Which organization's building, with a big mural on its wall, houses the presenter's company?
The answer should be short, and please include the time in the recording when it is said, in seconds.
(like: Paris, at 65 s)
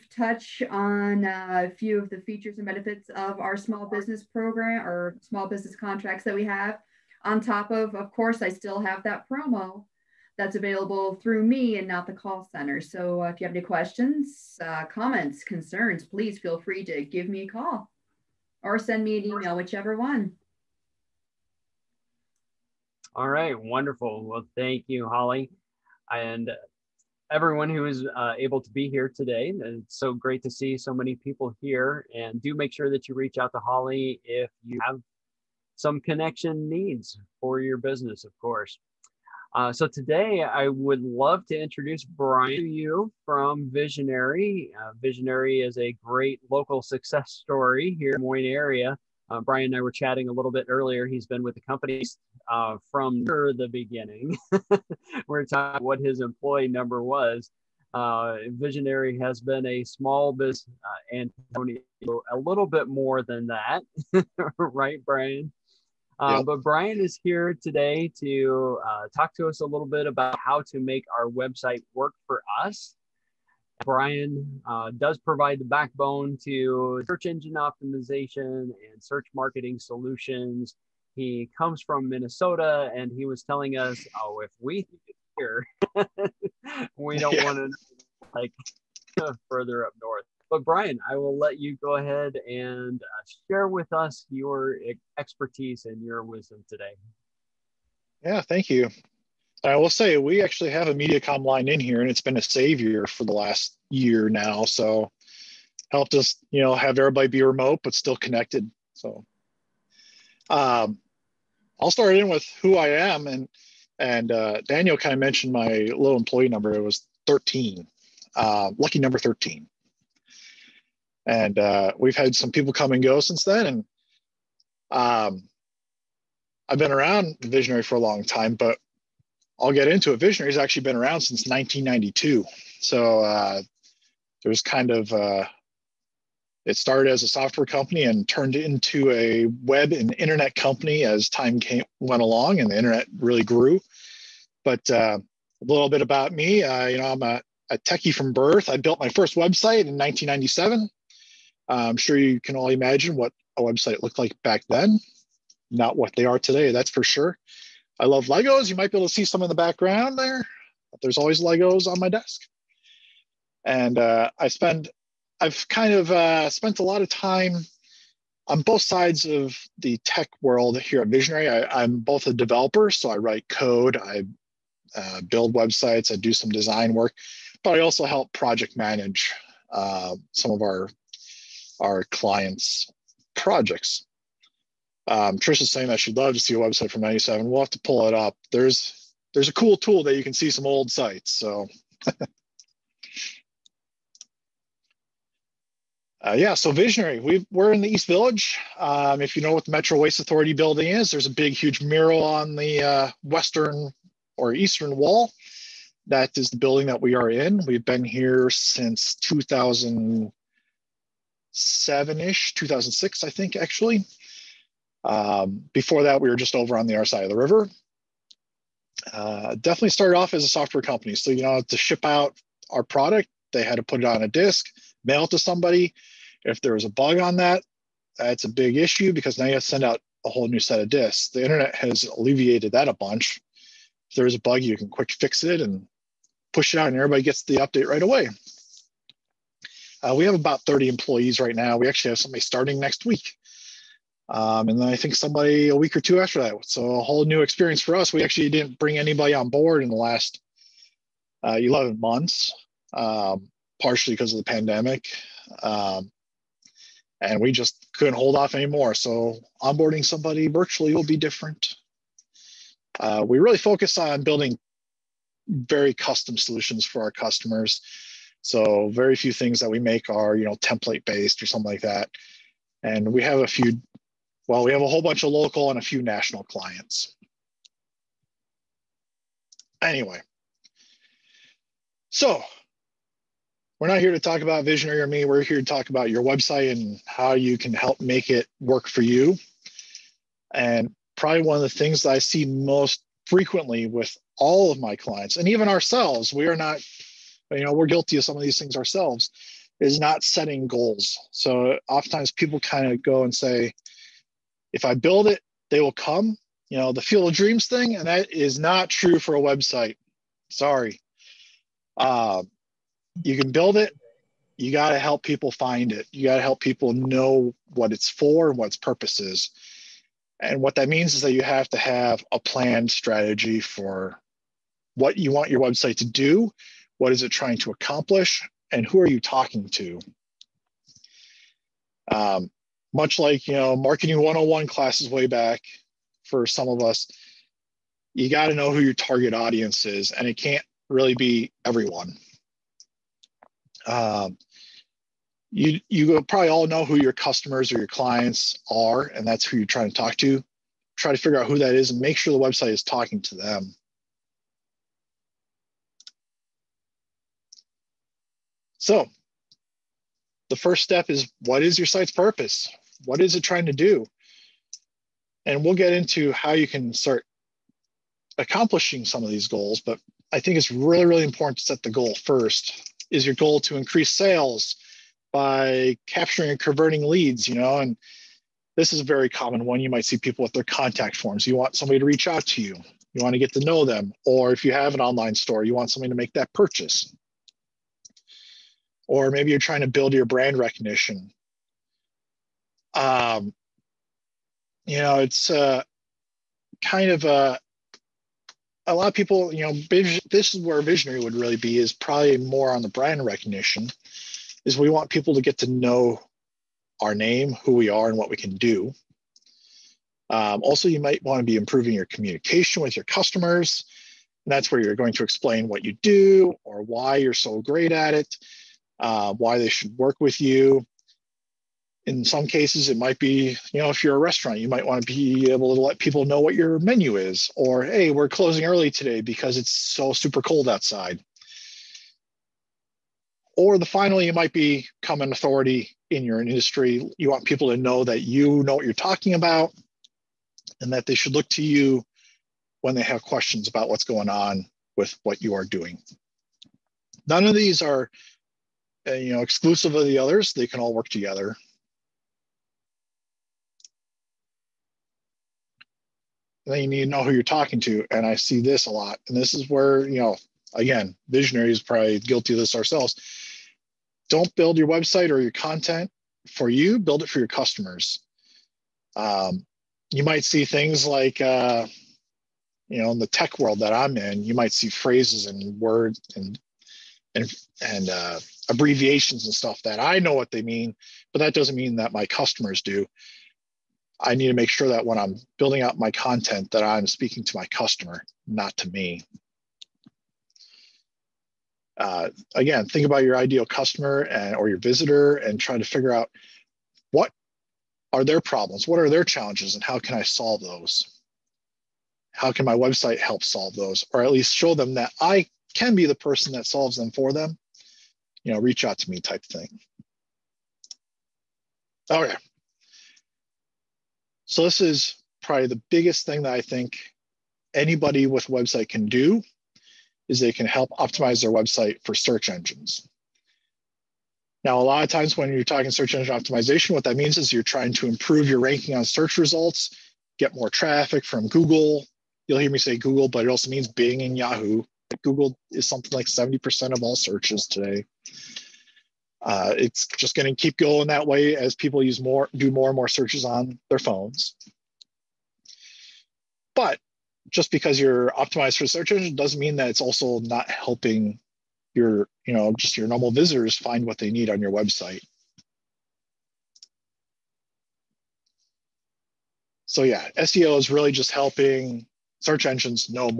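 Metro Waste Authority, at 199 s.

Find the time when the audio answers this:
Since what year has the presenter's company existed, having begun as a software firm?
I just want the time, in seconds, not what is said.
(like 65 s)
131 s.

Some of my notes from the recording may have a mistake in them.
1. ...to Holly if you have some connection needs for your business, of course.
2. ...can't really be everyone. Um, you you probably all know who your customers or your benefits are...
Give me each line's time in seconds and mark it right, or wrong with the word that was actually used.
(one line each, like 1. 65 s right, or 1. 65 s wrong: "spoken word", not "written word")
1. 33 s right
2. 340 s wrong: "clients", not "benefits".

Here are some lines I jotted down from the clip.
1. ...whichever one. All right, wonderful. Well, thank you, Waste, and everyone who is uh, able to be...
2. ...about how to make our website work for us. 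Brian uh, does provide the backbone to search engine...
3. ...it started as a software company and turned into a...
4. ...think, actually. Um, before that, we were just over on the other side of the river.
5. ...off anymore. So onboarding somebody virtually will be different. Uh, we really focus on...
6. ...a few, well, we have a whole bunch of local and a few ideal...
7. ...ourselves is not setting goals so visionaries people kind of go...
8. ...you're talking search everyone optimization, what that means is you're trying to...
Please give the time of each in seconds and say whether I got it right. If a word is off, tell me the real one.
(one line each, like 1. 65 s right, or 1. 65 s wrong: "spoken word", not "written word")
1. 19 s wrong: "Holly", not "Waste"
2. 70 s right
3. 136 s right
4. 213 s right
5. 258 s right
6. 273 s wrong: "national", not "ideal"
7. 298 s wrong: "oftentimes", not "visionaries"
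8. 525 s wrong: "engine", not "everyone".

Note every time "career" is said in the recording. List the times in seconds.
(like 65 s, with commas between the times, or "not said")
not said.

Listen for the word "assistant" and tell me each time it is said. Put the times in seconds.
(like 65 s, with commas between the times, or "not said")
not said.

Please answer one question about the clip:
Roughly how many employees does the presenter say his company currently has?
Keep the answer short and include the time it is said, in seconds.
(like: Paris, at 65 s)
30, at 240 s.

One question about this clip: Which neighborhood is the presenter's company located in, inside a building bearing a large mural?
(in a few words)
East Village.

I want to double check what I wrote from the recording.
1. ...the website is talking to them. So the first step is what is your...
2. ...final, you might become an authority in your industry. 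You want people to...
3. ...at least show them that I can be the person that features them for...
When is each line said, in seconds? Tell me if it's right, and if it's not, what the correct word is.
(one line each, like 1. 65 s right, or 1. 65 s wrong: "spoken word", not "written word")
1. 352 s right
2. 433 s right
3. 504 s wrong: "solves", not "features".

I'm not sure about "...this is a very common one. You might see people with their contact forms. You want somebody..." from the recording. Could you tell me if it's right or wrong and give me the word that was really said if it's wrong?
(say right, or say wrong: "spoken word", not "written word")
right.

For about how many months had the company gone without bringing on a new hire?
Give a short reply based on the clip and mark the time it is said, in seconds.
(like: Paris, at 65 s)
11, at 251 s.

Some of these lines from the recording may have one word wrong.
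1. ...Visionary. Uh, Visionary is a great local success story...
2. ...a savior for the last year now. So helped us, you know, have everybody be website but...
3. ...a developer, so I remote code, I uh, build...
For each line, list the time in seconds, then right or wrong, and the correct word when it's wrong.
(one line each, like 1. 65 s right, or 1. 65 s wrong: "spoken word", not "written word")
1. 43 s right
2. 102 s wrong: "remote", not "website"
3. 172 s wrong: "write", not "remote".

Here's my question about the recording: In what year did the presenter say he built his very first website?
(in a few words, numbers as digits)
1997.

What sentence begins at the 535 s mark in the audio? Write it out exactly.
Google is something like 70% of all searches today.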